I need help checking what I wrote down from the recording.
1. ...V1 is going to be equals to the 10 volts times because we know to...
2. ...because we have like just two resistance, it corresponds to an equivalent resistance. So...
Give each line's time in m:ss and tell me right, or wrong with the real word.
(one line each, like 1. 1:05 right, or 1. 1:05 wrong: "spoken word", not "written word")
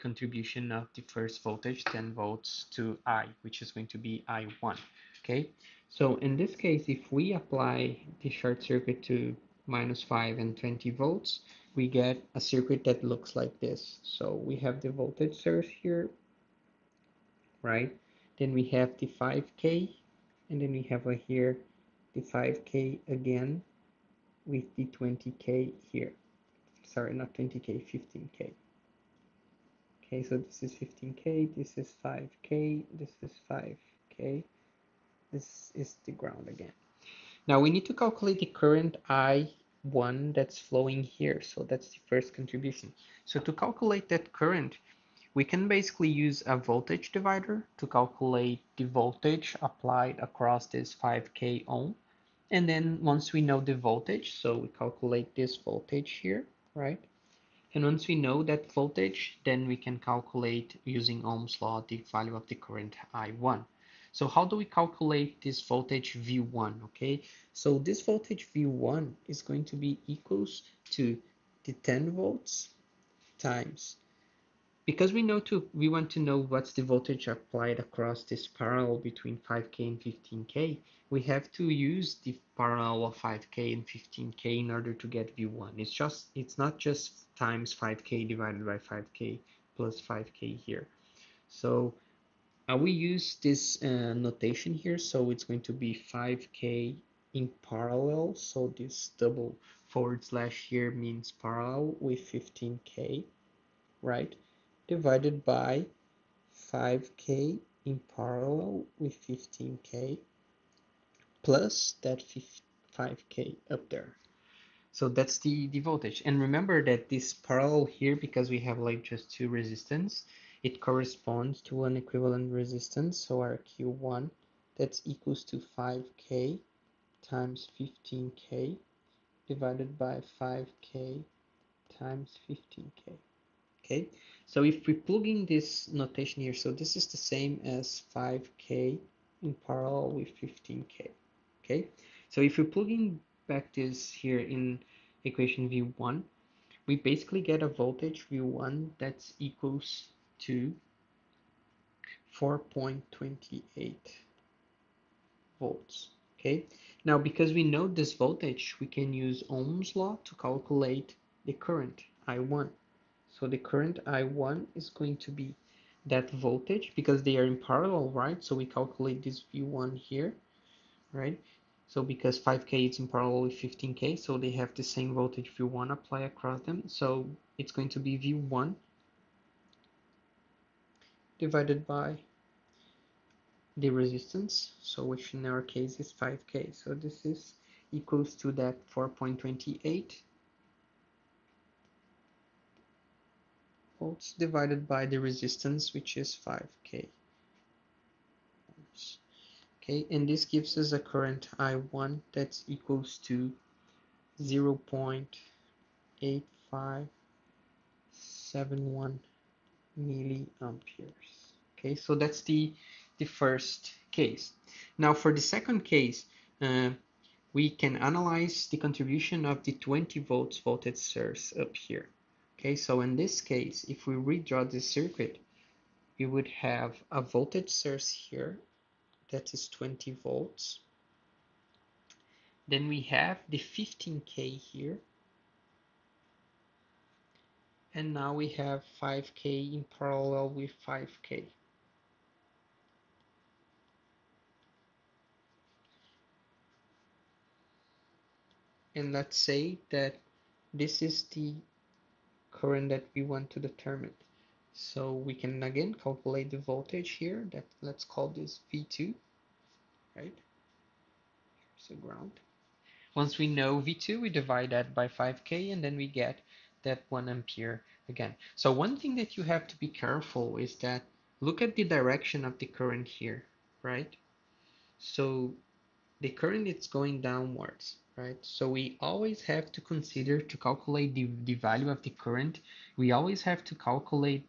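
1. 1:08 right
2. 1:58 right.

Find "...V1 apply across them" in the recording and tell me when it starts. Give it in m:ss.
2:55.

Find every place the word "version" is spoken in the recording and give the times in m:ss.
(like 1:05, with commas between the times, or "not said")
not said.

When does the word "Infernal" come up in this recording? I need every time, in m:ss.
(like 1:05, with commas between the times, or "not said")
not said.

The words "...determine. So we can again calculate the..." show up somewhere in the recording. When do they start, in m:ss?
4:13.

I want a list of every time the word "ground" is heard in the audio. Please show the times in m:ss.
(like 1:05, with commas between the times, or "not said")
0:36, 4:21.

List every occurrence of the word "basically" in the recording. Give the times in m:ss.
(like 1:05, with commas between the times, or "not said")
0:45, 2:26.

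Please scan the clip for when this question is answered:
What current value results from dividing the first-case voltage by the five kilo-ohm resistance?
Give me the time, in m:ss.
3:24.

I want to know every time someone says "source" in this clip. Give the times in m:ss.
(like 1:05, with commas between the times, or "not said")
0:15, 3:40, 3:47.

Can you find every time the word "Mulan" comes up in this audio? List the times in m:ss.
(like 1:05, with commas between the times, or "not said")
not said.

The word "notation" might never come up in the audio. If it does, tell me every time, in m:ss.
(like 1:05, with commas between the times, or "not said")
1:34, 2:15.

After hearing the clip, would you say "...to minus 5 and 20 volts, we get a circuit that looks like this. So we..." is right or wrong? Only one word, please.
right.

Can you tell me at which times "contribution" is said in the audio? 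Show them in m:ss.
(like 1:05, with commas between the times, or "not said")
0:42, 3:38.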